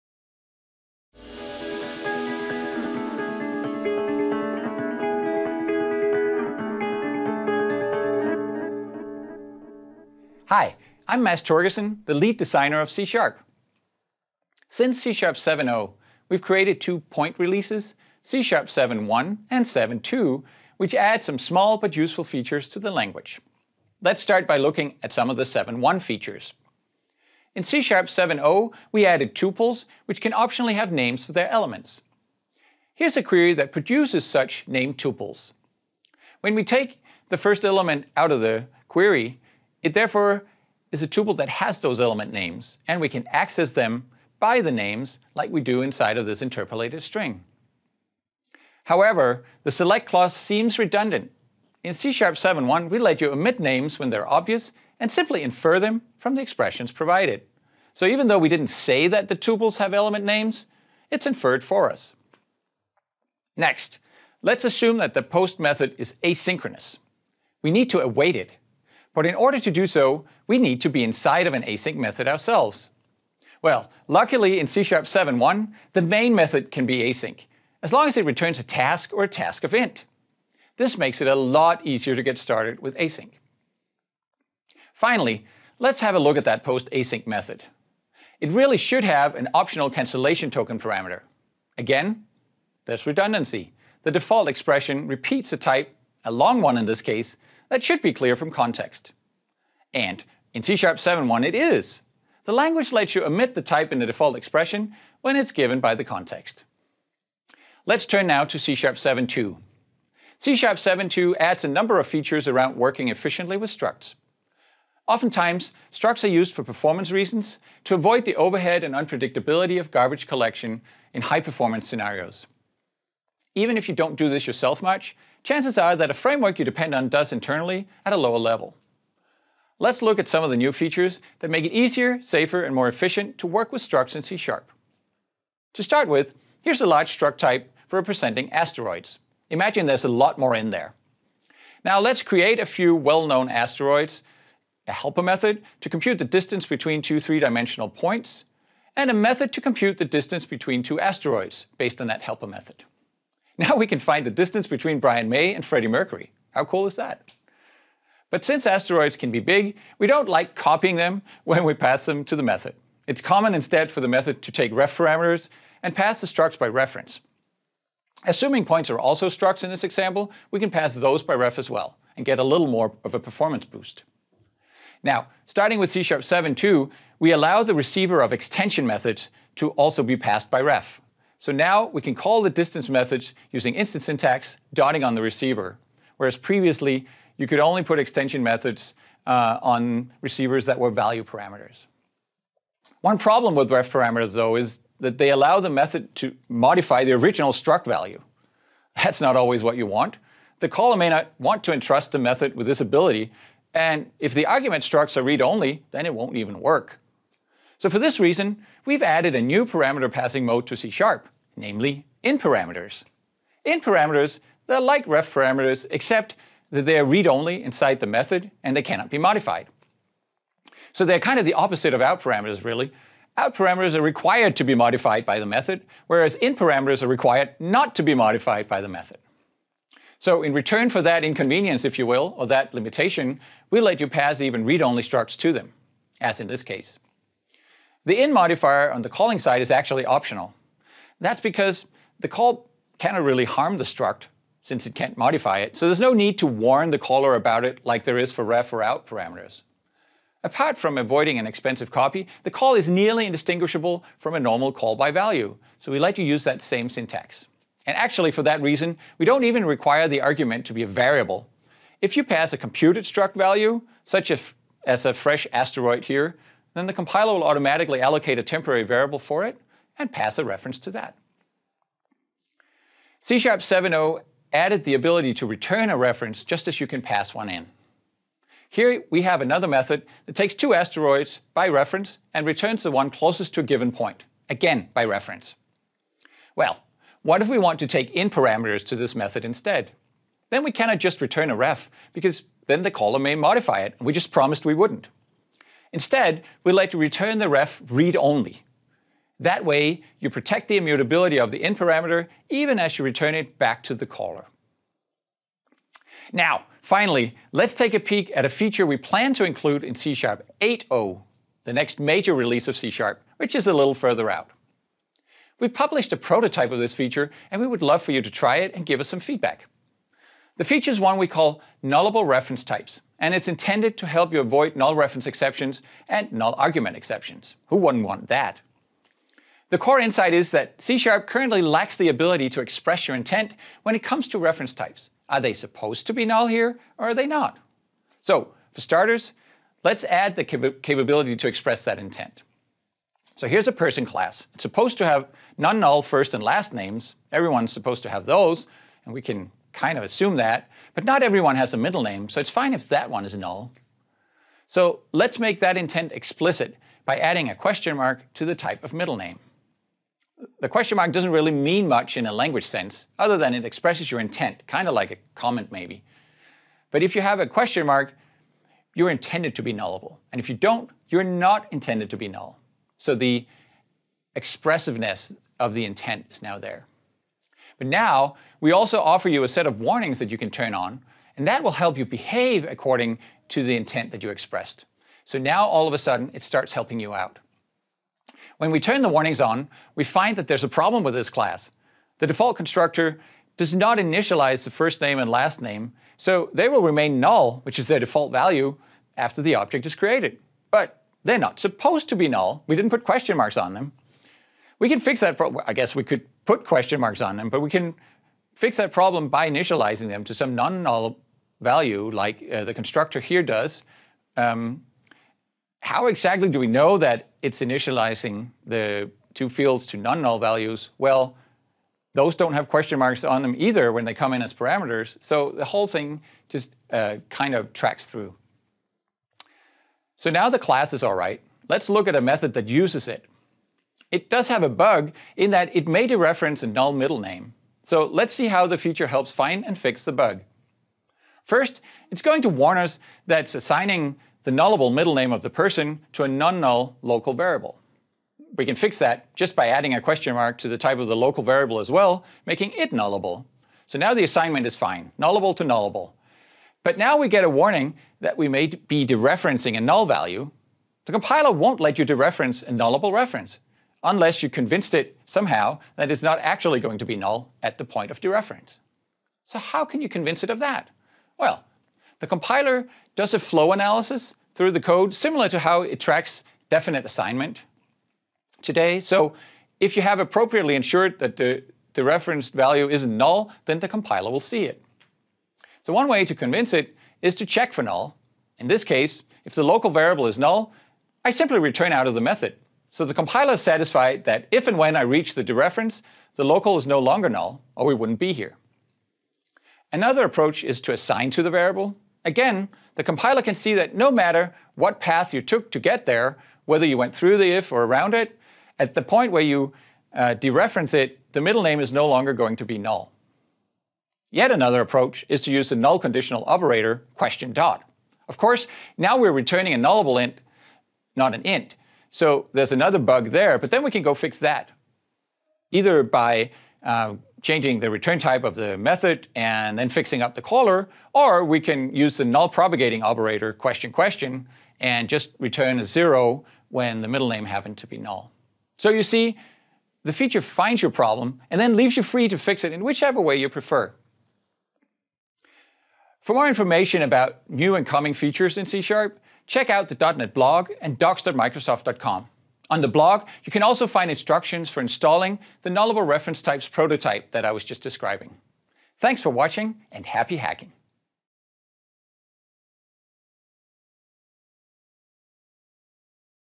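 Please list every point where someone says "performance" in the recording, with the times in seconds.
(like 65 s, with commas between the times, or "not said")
116 s, 121 s, 173 s.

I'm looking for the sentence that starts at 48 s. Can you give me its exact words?
However, the select clause seems redundant.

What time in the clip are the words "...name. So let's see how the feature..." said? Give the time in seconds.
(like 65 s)
437 s.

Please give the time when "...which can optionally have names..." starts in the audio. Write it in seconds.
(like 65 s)
30 s.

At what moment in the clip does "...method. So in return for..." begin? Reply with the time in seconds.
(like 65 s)
228 s.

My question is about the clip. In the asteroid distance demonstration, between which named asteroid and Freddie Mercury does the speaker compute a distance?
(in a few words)
Brian May.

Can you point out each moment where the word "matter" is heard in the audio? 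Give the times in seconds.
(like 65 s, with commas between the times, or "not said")
504 s.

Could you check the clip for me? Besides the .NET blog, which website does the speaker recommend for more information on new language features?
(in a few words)
docs.microsoft.com.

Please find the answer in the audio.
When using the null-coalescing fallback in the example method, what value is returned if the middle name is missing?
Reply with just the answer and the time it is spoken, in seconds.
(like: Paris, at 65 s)
0, at 535 s.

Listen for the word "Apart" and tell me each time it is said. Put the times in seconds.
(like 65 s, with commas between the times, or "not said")
250 s.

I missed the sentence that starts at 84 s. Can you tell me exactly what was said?
Finally, let's have a look at that post async method.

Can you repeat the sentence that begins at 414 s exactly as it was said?
Um, how exactly do we know that it's initializing the two fields to non-null values?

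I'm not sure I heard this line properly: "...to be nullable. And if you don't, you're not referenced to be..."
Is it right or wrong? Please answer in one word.
wrong.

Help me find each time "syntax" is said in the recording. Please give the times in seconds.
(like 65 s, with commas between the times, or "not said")
184 s, 256 s.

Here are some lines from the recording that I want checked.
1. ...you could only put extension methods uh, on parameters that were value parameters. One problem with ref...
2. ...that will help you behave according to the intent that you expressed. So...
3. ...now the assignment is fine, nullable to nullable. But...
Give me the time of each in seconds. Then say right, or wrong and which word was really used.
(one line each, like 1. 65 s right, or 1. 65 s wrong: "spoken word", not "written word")
1. 187 s wrong: "receivers", not "parameters"
2. 381 s right
3. 453 s right.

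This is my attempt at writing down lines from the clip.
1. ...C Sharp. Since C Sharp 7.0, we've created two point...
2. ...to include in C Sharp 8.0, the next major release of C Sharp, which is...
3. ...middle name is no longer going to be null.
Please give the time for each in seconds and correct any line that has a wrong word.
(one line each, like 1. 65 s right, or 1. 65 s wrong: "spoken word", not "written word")
1. 12 s right
2. 309 s right
3. 511 s right.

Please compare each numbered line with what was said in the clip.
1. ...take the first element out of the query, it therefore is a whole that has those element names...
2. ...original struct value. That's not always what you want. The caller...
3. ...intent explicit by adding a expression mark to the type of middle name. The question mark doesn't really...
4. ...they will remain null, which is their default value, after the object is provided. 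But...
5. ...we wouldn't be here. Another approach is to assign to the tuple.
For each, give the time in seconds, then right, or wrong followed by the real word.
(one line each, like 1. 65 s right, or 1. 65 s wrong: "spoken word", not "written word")
1. 36 s wrong: "tuple", not "whole"
2. 197 s right
3. 355 s wrong: "question", not "expression"
4. 396 s wrong: "created", not "provided"
5. 497 s wrong: "variable", not "tuple".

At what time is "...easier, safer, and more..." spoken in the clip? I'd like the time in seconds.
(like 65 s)
131 s.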